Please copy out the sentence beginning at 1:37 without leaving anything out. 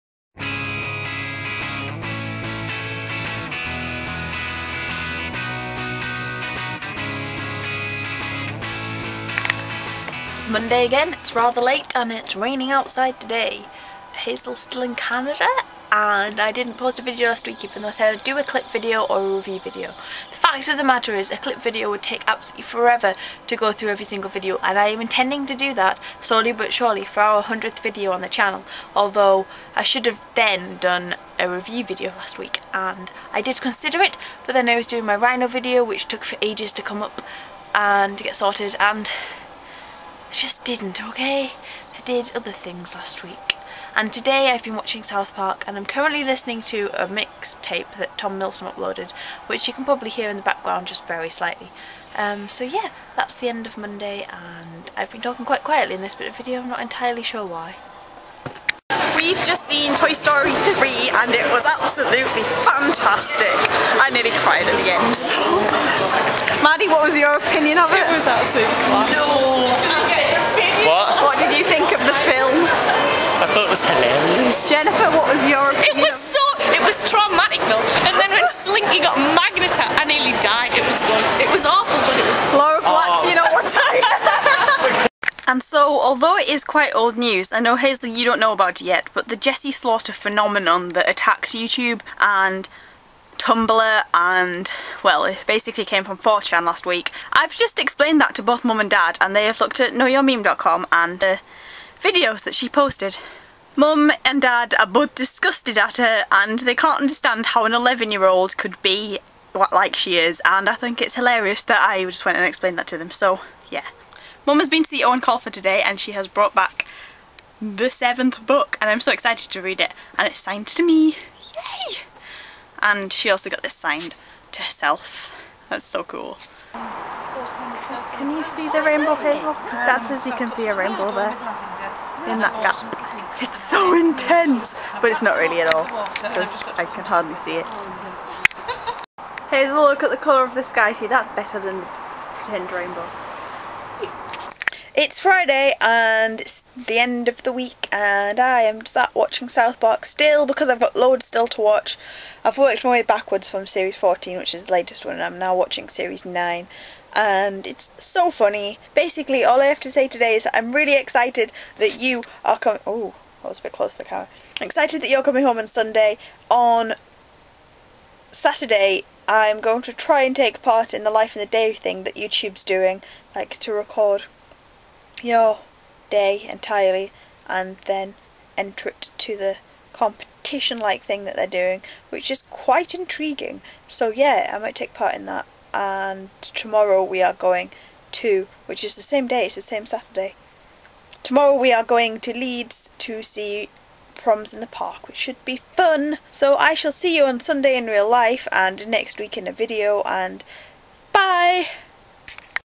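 I've just explained that to both mum and dad and they have looked at knowyourmeme.com and the videos that she posted.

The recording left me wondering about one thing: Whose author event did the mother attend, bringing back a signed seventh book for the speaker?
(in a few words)
Eoin Colfer.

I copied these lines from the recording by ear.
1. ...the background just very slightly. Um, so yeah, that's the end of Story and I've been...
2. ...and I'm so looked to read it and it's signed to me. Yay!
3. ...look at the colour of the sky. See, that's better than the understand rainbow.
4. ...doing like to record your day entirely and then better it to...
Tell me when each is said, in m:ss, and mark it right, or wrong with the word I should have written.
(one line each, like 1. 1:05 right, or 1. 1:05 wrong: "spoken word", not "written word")
1. 0:50 wrong: "Monday", not "Story"
2. 1:58 wrong: "excited", not "looked"
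3. 2:19 wrong: "pretend", not "understand"
4. 2:52 wrong: "enter", not "better".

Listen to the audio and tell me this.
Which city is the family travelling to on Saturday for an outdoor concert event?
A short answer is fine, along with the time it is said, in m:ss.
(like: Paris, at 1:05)
Leeds, at 3:12.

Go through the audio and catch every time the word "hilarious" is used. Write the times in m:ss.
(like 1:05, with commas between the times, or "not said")
1:51.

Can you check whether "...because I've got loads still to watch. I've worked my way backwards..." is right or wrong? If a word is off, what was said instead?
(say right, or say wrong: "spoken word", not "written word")
right.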